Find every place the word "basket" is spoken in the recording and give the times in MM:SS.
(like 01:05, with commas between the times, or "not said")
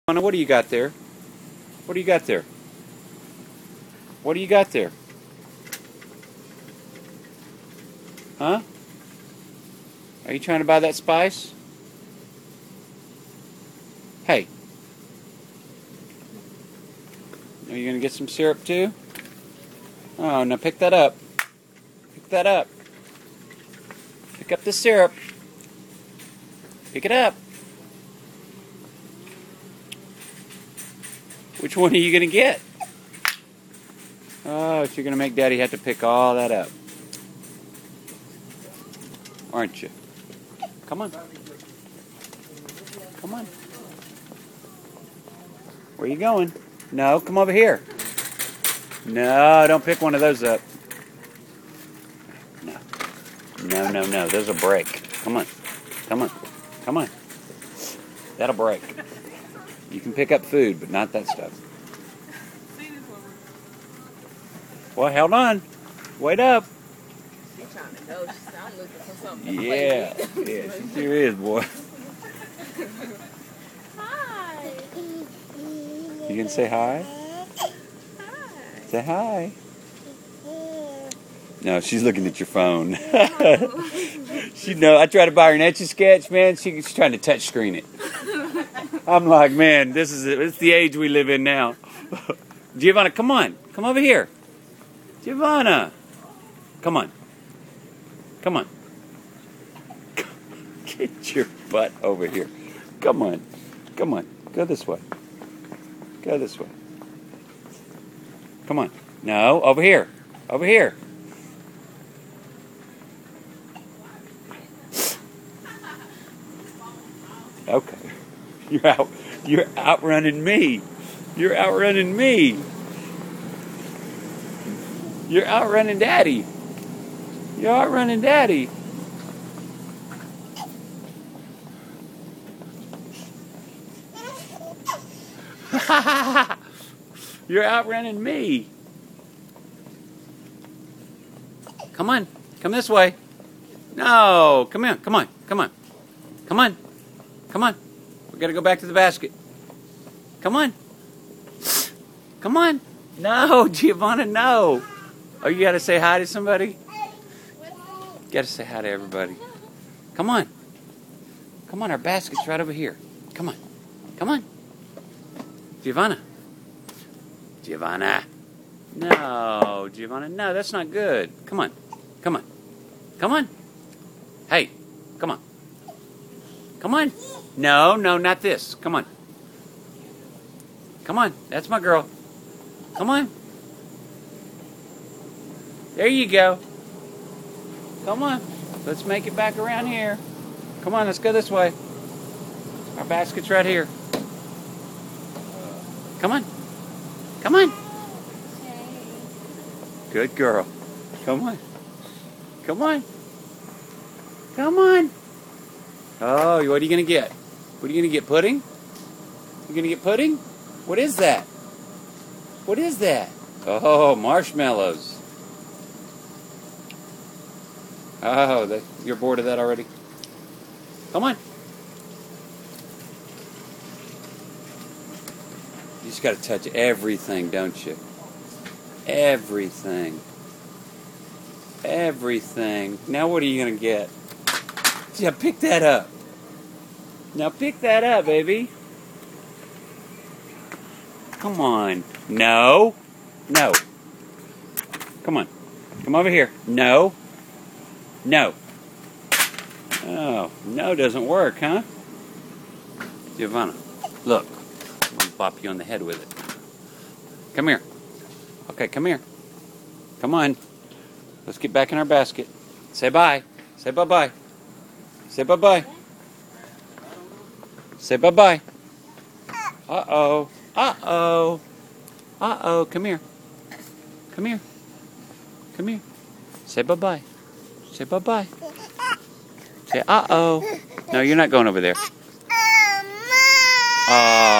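02:28, 02:41, 03:13, 04:22.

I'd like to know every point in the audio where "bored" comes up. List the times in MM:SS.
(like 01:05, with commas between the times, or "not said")
03:39.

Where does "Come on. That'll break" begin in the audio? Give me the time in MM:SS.
00:56.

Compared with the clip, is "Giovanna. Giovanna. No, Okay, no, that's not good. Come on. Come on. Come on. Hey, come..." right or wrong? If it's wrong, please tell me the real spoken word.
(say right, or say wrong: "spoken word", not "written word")
wrong: "Giovanna", not "Okay".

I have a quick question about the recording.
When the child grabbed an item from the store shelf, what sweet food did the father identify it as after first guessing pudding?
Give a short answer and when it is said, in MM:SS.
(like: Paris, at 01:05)
Marshmallows, at 03:34.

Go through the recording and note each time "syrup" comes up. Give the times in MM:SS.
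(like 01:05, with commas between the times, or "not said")
00:18, 00:24.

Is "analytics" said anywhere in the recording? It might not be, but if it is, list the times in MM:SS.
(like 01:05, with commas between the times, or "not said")
not said.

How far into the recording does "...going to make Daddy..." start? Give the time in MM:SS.
00:35.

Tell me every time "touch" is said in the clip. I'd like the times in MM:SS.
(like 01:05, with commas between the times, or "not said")
01:27, 03:46.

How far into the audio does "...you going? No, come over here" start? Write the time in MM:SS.
00:46.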